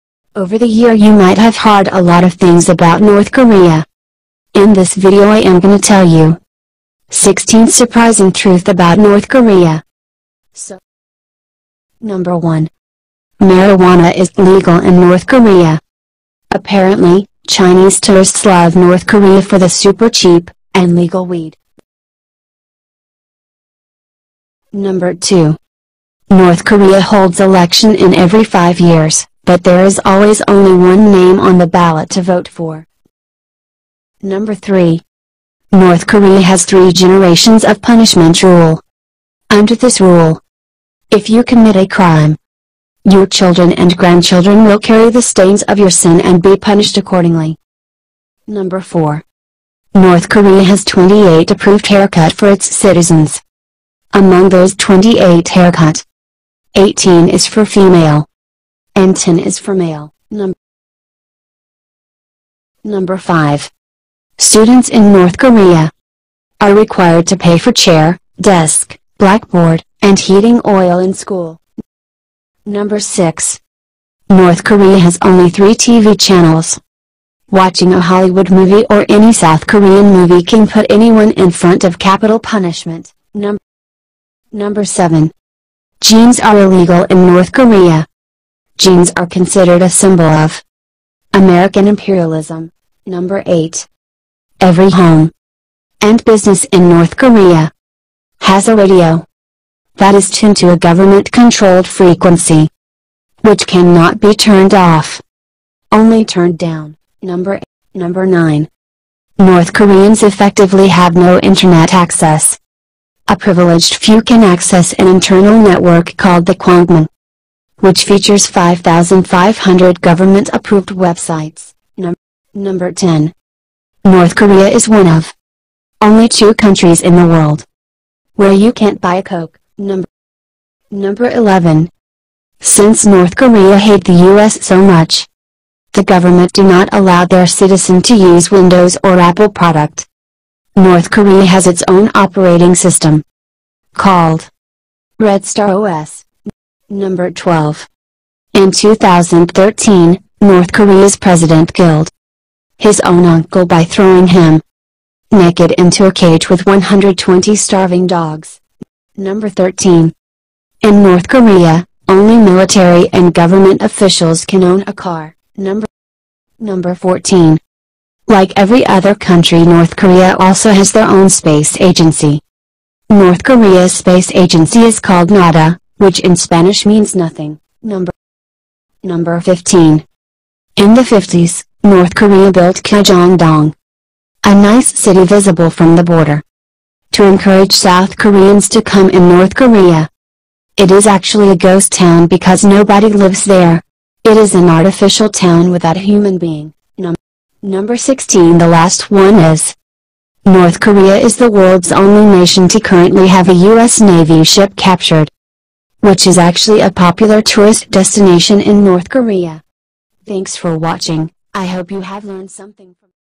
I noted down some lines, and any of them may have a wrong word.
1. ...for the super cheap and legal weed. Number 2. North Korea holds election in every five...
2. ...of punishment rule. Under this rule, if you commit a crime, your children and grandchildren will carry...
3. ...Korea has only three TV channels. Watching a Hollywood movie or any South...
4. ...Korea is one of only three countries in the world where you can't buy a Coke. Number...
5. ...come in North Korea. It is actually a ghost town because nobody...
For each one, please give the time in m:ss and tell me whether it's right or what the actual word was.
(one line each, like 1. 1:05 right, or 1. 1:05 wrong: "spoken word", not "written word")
1. 0:19 right
2. 0:37 right
3. 1:14 right
4. 2:04 wrong: "two", not "three"
5. 3:08 right.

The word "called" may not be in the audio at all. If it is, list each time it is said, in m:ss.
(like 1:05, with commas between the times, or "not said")
1:56, 2:23, 2:54.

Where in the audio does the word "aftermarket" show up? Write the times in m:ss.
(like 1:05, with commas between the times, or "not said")
not said.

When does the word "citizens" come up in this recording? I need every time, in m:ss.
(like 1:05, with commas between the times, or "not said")
0:52, 2:17.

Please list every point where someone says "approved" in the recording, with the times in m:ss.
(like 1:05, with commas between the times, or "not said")
0:51, 2:00.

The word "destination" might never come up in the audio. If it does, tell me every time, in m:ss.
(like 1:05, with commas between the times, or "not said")
3:27.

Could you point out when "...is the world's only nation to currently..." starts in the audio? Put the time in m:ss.
3:21.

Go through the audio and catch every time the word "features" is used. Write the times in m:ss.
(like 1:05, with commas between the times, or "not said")
1:58.